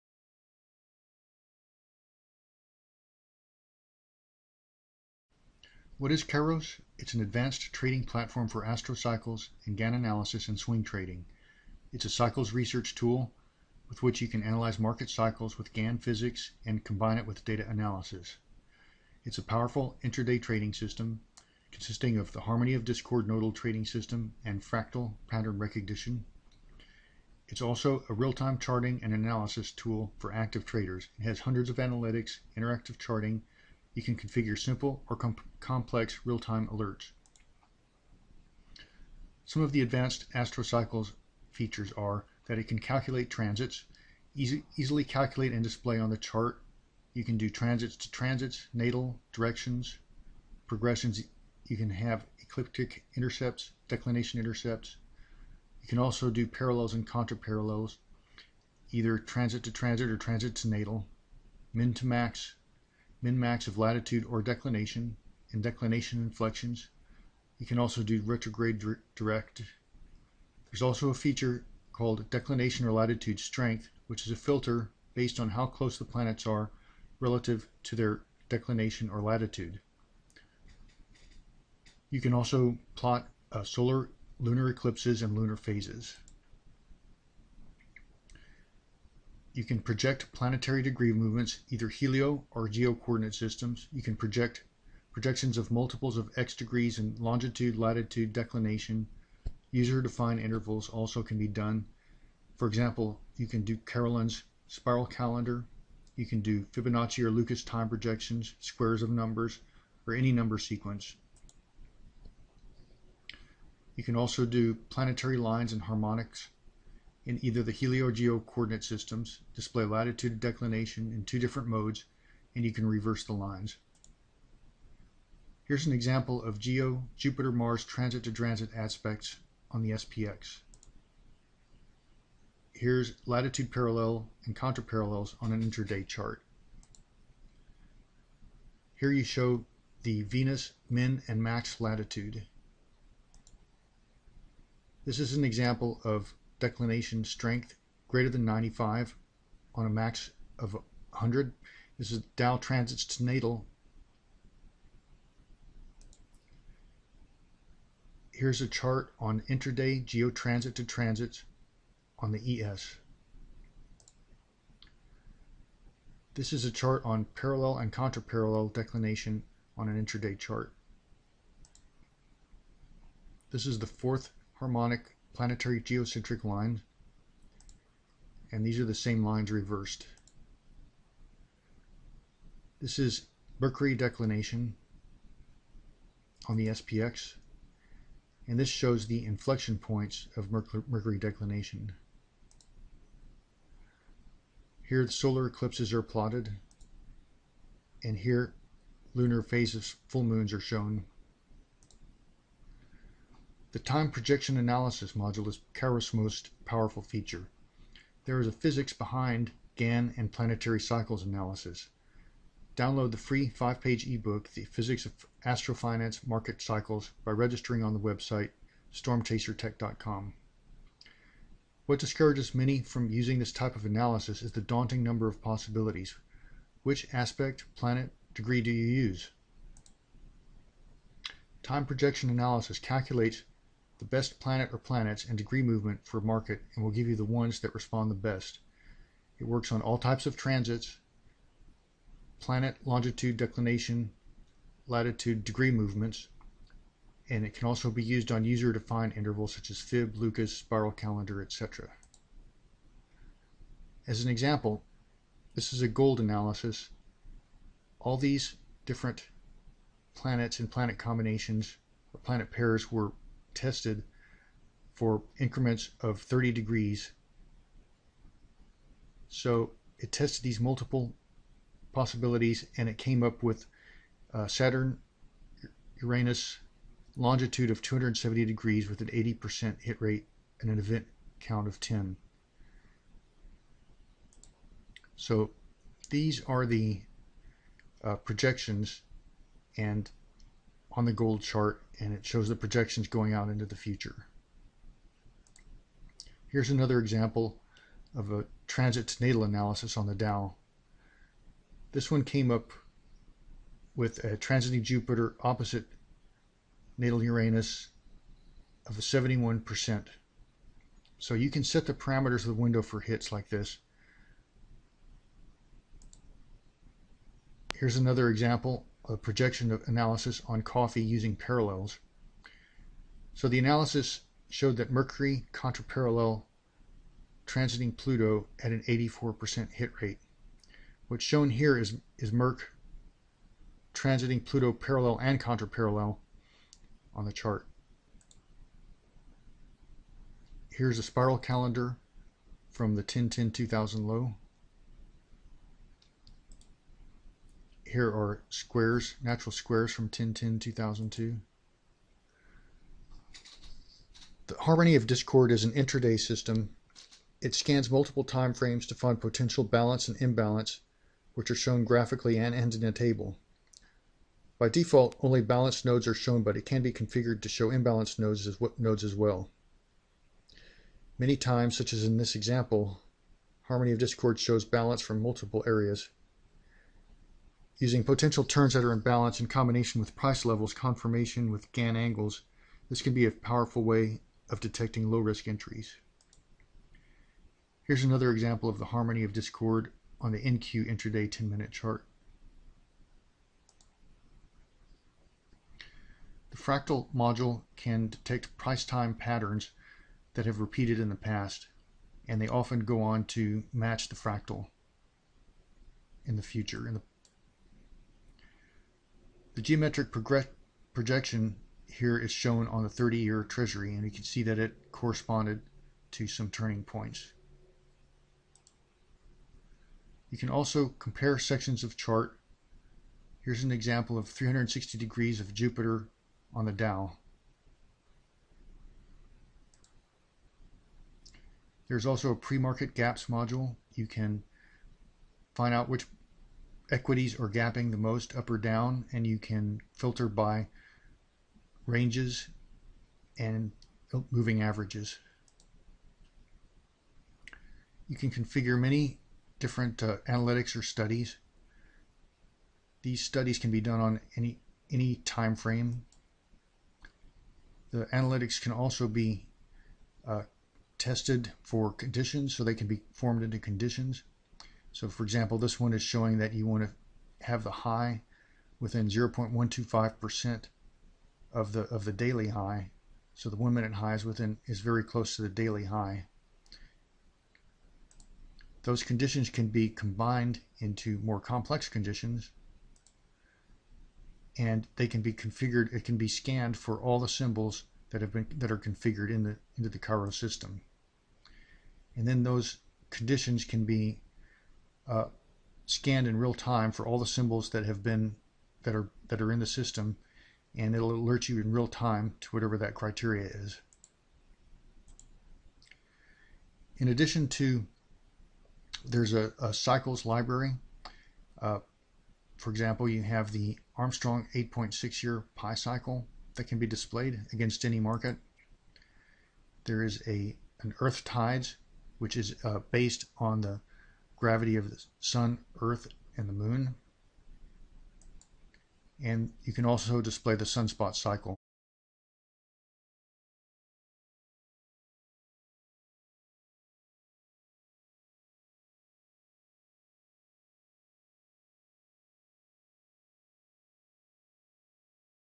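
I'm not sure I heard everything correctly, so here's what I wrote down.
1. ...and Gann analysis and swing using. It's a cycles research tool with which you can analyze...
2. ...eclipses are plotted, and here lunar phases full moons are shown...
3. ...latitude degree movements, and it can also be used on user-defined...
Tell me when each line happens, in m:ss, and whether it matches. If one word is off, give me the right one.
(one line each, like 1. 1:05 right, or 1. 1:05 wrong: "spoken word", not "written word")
1. 0:09 wrong: "trading", not "using"
2. 3:15 right
3. 4:04 right.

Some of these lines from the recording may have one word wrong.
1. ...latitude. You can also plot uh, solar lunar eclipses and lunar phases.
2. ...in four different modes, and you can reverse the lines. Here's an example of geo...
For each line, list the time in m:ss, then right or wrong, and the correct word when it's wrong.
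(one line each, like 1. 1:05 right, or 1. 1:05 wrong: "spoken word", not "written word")
1. 1:19 right
2. 2:01 wrong: "two", not "four".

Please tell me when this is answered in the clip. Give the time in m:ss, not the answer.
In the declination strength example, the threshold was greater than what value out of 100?
2:28.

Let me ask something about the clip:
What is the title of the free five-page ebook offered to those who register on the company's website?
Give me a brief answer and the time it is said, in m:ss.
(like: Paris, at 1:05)
The Physics of Astrofinance Market Cycles, at 3:34.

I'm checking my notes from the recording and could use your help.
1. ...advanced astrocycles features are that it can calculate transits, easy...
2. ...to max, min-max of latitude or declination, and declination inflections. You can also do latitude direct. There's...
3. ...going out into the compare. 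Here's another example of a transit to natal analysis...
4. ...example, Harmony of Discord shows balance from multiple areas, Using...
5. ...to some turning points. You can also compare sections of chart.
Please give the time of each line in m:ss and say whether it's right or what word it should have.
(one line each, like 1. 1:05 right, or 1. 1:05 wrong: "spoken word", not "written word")
1. 0:39 right
2. 1:01 wrong: "retrograde", not "latitude"
3. 4:53 wrong: "future", not "compare"
4. 6:12 right
5. 6:56 right.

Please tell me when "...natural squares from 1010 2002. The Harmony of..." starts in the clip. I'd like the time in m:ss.
5:49.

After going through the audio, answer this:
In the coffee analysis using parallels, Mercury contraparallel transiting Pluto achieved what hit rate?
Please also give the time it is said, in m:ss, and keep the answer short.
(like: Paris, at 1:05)
84%, at 5:28.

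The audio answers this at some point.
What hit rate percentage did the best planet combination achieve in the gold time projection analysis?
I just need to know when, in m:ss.
4:39.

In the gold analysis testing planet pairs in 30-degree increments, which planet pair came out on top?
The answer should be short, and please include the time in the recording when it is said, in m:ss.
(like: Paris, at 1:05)
Saturn Uranus, at 4:34.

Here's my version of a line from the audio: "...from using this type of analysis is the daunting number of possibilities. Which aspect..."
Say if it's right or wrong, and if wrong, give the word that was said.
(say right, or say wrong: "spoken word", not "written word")
right.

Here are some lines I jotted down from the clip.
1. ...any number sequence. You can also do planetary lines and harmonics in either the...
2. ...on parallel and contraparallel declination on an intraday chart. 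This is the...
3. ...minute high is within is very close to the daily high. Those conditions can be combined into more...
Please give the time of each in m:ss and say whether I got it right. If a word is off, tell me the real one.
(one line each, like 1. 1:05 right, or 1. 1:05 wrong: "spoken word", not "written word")
1. 1:50 right
2. 2:47 right
3. 7:53 right.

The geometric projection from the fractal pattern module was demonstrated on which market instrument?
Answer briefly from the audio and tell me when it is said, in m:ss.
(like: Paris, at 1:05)
30-year treasury, at 6:52.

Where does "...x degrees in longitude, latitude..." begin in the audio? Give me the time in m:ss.
1:36.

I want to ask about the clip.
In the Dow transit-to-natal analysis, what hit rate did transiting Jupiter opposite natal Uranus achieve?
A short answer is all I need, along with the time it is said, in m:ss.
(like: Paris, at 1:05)
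71%, at 5:08.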